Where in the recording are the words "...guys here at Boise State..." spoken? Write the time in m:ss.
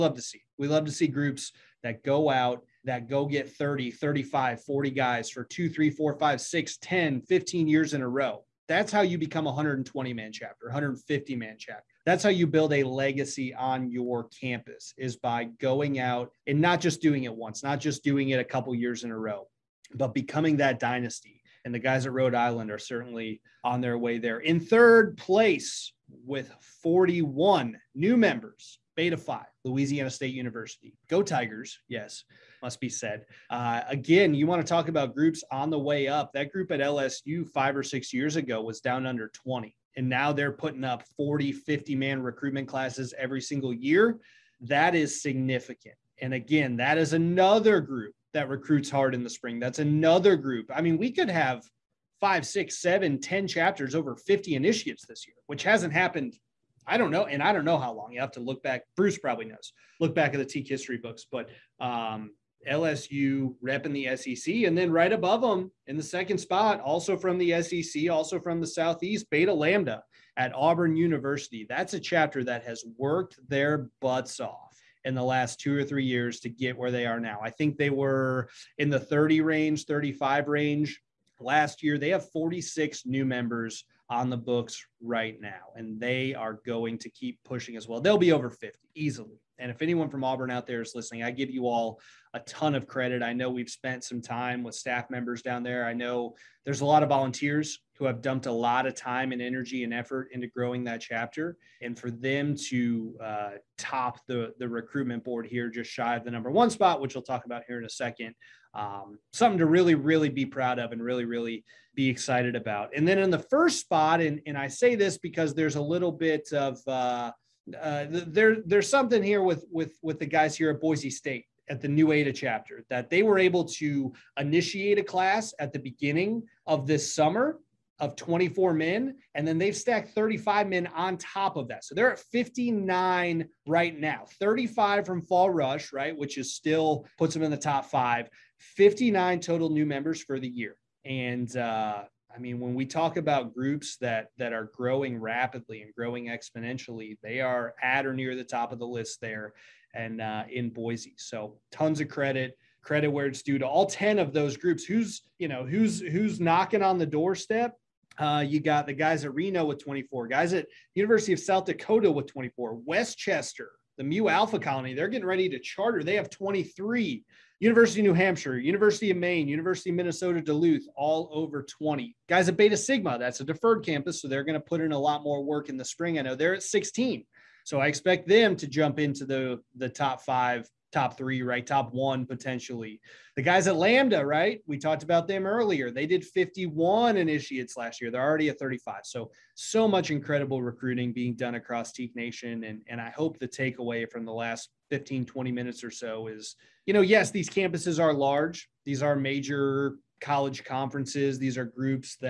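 2:00.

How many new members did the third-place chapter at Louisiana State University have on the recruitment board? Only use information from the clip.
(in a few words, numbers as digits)
41.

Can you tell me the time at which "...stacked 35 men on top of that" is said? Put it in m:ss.
2:09.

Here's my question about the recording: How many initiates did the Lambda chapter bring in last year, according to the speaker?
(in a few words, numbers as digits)
51.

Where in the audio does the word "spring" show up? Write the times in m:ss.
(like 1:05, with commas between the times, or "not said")
0:49, 2:55.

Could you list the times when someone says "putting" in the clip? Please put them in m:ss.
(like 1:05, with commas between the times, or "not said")
0:40.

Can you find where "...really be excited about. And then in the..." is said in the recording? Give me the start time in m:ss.
1:51.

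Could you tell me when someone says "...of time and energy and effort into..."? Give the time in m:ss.
1:38.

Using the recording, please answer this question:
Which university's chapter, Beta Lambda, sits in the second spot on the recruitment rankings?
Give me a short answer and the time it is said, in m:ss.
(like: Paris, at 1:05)
Auburn University, at 1:10.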